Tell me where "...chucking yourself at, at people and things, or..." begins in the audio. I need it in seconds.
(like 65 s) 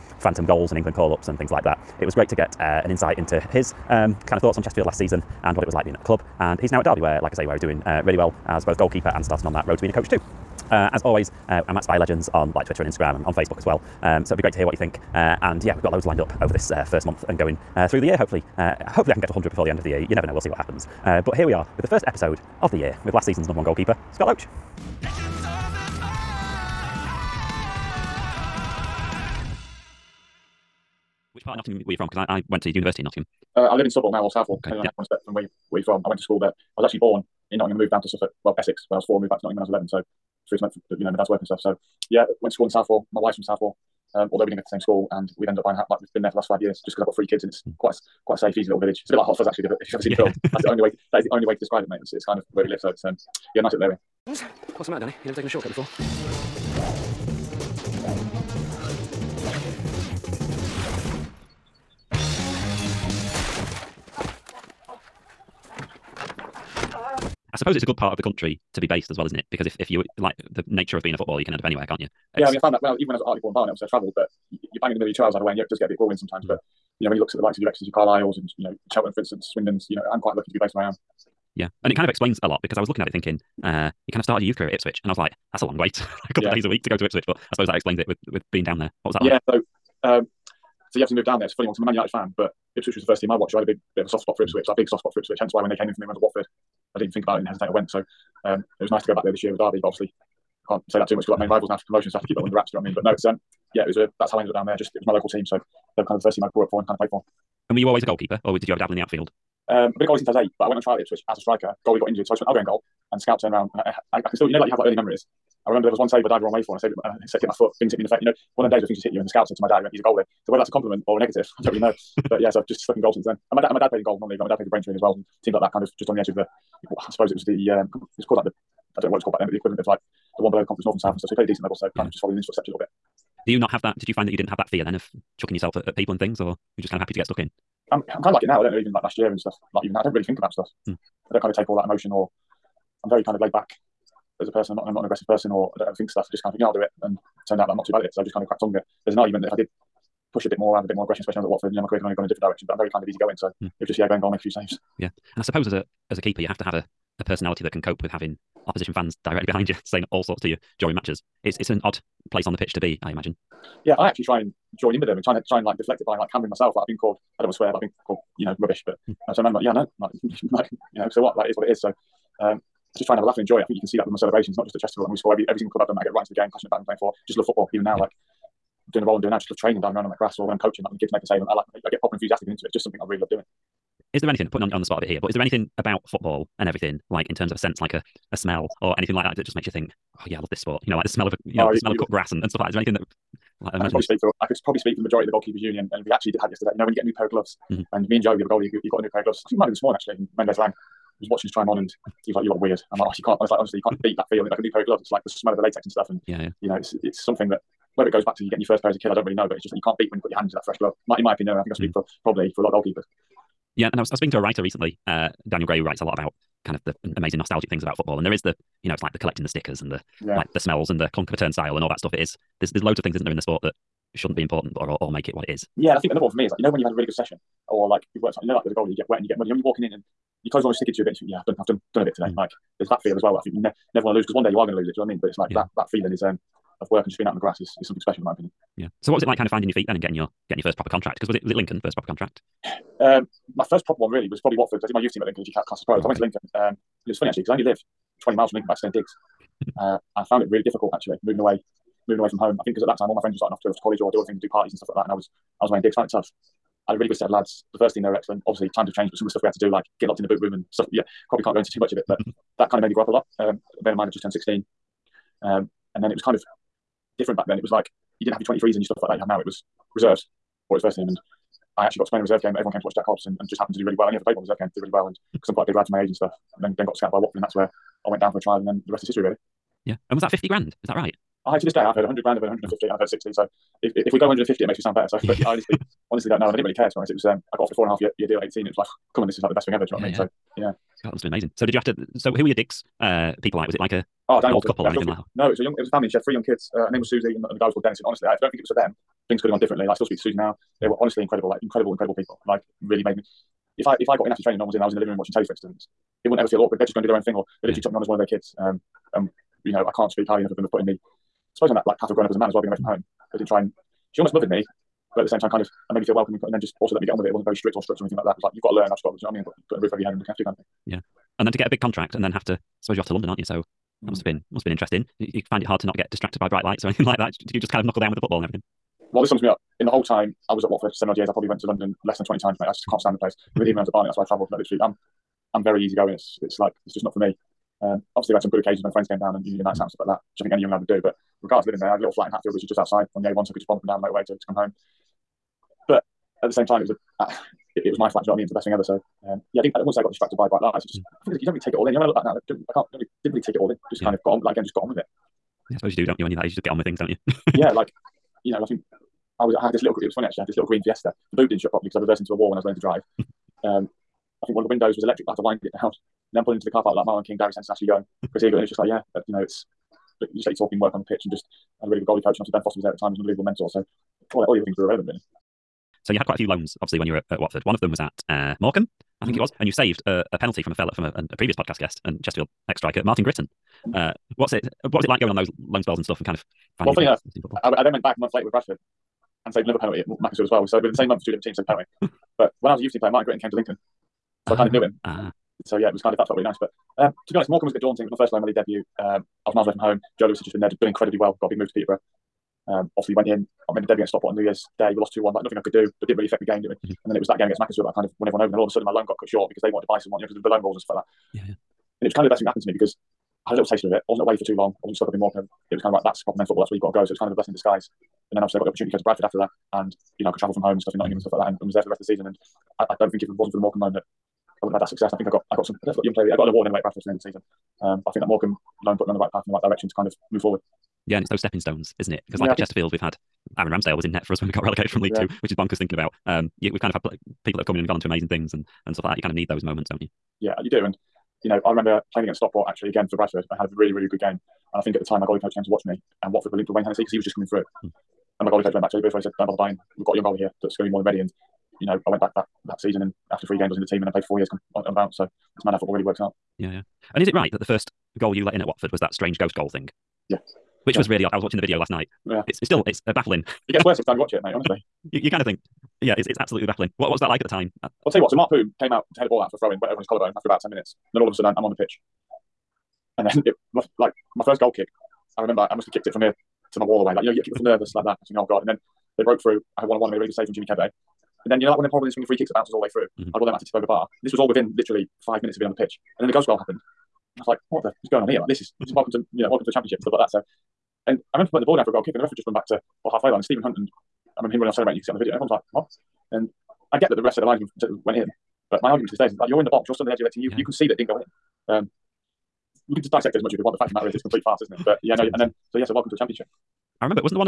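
135 s.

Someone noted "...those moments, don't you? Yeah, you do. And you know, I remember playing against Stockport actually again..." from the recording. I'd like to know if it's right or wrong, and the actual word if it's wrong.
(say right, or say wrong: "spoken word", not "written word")
right.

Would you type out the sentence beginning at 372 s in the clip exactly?
And obviously, Ben Foster was there at the time, he was an unbelievable mentor.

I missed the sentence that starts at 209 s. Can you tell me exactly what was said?
But it's just that you can't beat when you put your hand into that fresh glove.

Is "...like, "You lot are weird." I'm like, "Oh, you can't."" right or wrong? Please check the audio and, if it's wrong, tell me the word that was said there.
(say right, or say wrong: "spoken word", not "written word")
right.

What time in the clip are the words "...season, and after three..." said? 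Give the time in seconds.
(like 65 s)
452 s.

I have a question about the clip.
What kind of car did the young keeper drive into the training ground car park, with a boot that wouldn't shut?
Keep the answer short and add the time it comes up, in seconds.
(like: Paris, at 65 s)
Green Fiesta, at 360 s.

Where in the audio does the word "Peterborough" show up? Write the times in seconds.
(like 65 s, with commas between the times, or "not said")
401 s.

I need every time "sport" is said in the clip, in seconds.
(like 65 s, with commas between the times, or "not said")
190 s, 223 s.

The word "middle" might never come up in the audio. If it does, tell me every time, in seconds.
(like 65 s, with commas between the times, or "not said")
74 s.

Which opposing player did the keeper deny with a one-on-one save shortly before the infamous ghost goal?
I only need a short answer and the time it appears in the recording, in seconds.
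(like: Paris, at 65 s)
Jimmy Kebe, at 480 s.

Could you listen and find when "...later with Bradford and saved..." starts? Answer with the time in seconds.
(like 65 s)
388 s.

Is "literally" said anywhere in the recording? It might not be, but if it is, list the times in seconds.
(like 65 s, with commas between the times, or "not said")
307 s, 334 s, 484 s.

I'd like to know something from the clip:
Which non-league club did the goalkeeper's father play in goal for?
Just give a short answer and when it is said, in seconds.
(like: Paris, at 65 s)
Braintree, at 124 s.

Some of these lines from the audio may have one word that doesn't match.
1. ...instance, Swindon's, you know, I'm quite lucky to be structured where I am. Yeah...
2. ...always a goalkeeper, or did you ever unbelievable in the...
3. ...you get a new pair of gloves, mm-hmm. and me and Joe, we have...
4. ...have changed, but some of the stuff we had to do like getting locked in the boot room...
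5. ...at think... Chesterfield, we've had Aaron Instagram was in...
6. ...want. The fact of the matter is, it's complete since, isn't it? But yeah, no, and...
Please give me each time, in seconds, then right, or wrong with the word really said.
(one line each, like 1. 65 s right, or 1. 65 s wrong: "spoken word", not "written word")
1. 79 s wrong: "based", not "structured"
2. 107 s wrong: "dabble", not "unbelievable"
3. 196 s right
4. 258 s right
5. 432 s wrong: "Ramsdale", not "Instagram"
6. 503 s wrong: "farce", not "since".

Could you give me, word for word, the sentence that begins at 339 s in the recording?
out and stuff like that, which I think any young lad would do.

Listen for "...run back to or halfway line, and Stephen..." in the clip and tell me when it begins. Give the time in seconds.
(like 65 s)
492 s.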